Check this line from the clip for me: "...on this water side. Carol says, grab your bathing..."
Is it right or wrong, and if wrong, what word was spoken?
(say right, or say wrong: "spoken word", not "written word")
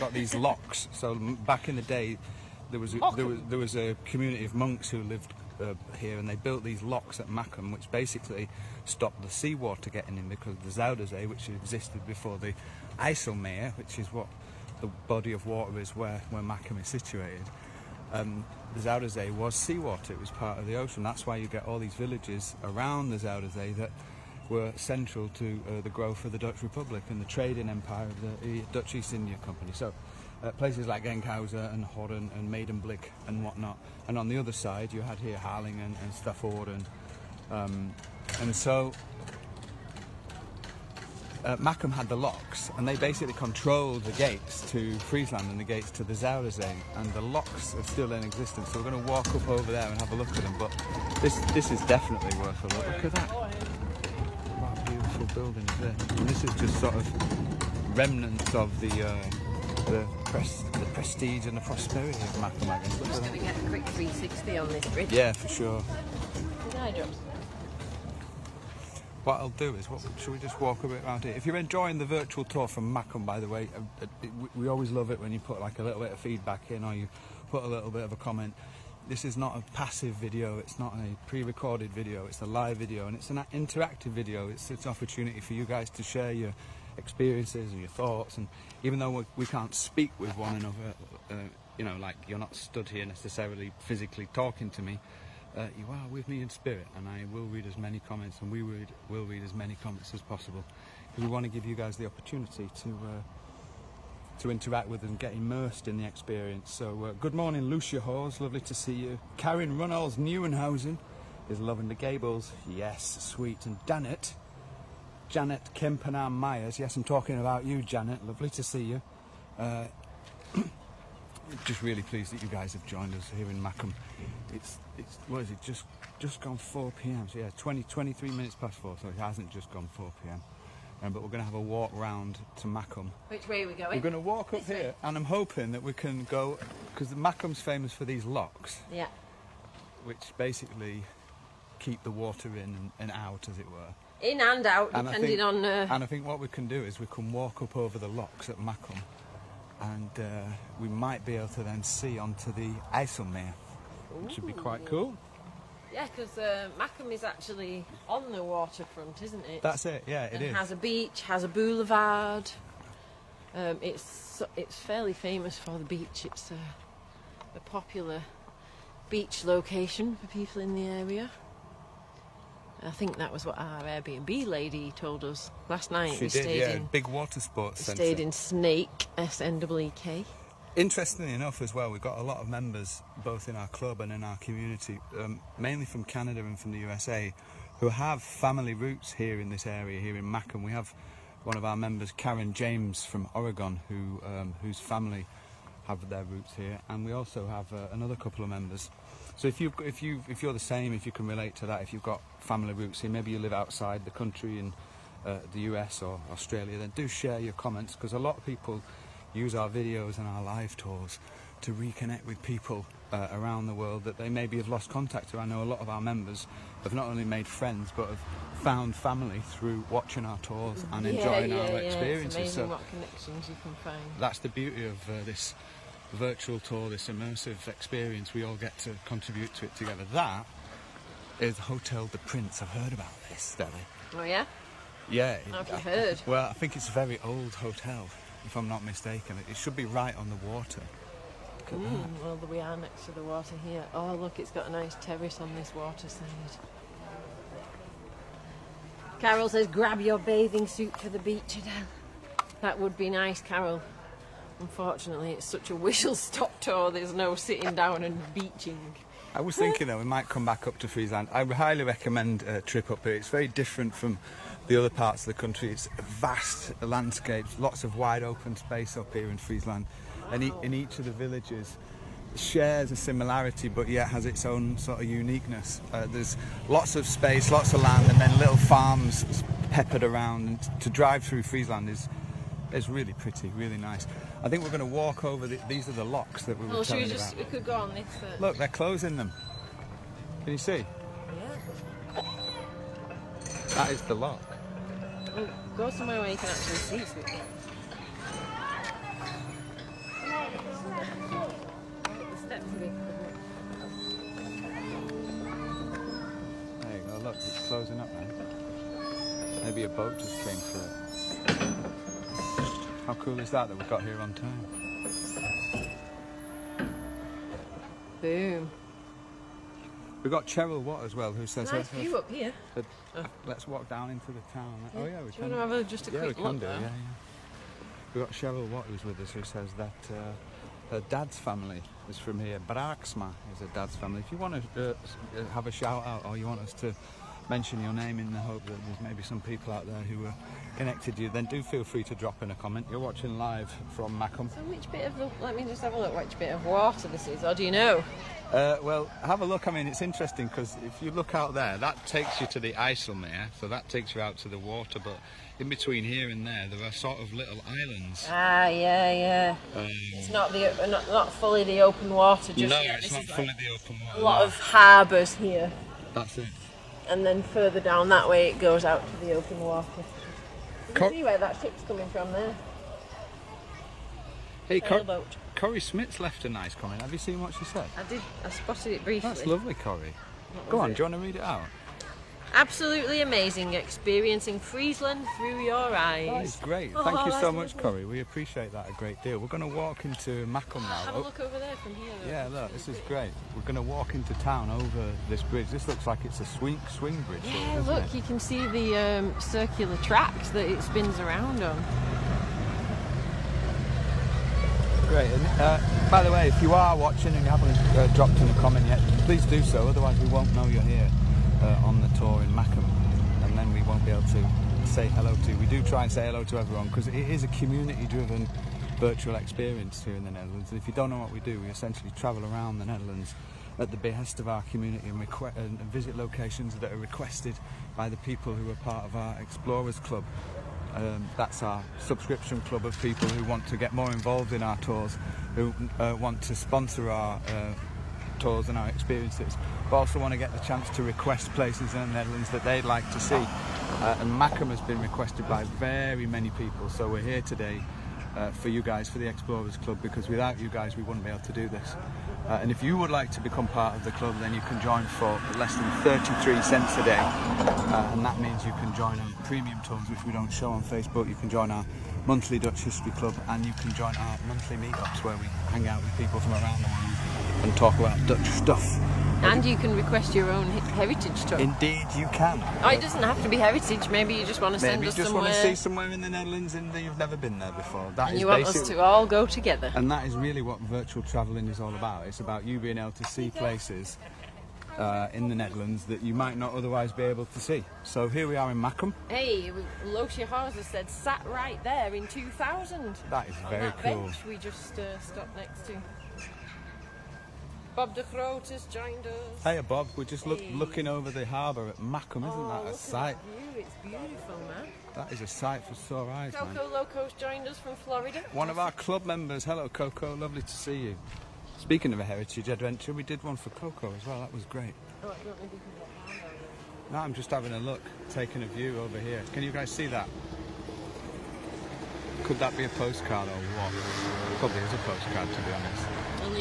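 right.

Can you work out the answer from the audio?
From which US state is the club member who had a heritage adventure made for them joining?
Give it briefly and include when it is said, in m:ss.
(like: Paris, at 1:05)
Florida, at 8:27.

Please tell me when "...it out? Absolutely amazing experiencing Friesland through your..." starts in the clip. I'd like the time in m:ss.
6:21.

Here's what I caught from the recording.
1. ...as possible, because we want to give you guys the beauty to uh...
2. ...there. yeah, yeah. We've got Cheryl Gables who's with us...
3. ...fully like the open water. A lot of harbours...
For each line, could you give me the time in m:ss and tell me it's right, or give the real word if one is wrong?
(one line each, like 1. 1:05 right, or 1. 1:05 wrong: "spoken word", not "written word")
1. 1:40 wrong: "opportunity", not "beauty"
2. 5:26 wrong: "Watt", not "Gables"
3. 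6:03 right.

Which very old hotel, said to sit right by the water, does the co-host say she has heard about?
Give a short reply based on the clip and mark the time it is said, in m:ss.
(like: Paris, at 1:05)
Hotel de Prince, at 3:51.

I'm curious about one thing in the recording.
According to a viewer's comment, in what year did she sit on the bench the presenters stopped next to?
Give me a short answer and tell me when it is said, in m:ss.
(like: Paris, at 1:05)
2000, at 8:12.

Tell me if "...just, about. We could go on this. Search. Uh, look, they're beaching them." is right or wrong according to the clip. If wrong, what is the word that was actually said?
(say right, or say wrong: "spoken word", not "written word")
wrong: "closing", not "beaching".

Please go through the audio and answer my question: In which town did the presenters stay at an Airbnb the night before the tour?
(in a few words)
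Sneek.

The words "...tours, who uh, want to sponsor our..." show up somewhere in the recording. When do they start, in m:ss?
7:14.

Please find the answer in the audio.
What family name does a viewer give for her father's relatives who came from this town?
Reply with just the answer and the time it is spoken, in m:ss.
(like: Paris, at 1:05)
Braxma, at 5:32.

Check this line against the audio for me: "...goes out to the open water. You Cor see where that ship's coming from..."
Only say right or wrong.
right.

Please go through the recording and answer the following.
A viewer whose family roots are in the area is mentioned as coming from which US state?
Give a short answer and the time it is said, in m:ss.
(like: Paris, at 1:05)
Oregon, at 3:13.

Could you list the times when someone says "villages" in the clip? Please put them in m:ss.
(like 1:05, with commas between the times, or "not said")
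0:21, 4:31.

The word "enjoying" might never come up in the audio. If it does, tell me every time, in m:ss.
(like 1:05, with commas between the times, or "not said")
1:11, 3:41.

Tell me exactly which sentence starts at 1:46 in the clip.
So, uh, good morning, Lucia Hawes, lovely to see you.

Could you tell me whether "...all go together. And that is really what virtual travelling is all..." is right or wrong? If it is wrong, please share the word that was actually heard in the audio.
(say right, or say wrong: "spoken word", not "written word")
right.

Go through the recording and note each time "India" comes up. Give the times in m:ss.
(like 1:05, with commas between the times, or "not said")
0:29.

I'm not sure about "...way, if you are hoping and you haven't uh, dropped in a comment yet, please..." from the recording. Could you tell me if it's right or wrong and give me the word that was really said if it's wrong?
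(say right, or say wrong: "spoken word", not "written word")
wrong: "watching", not "hoping".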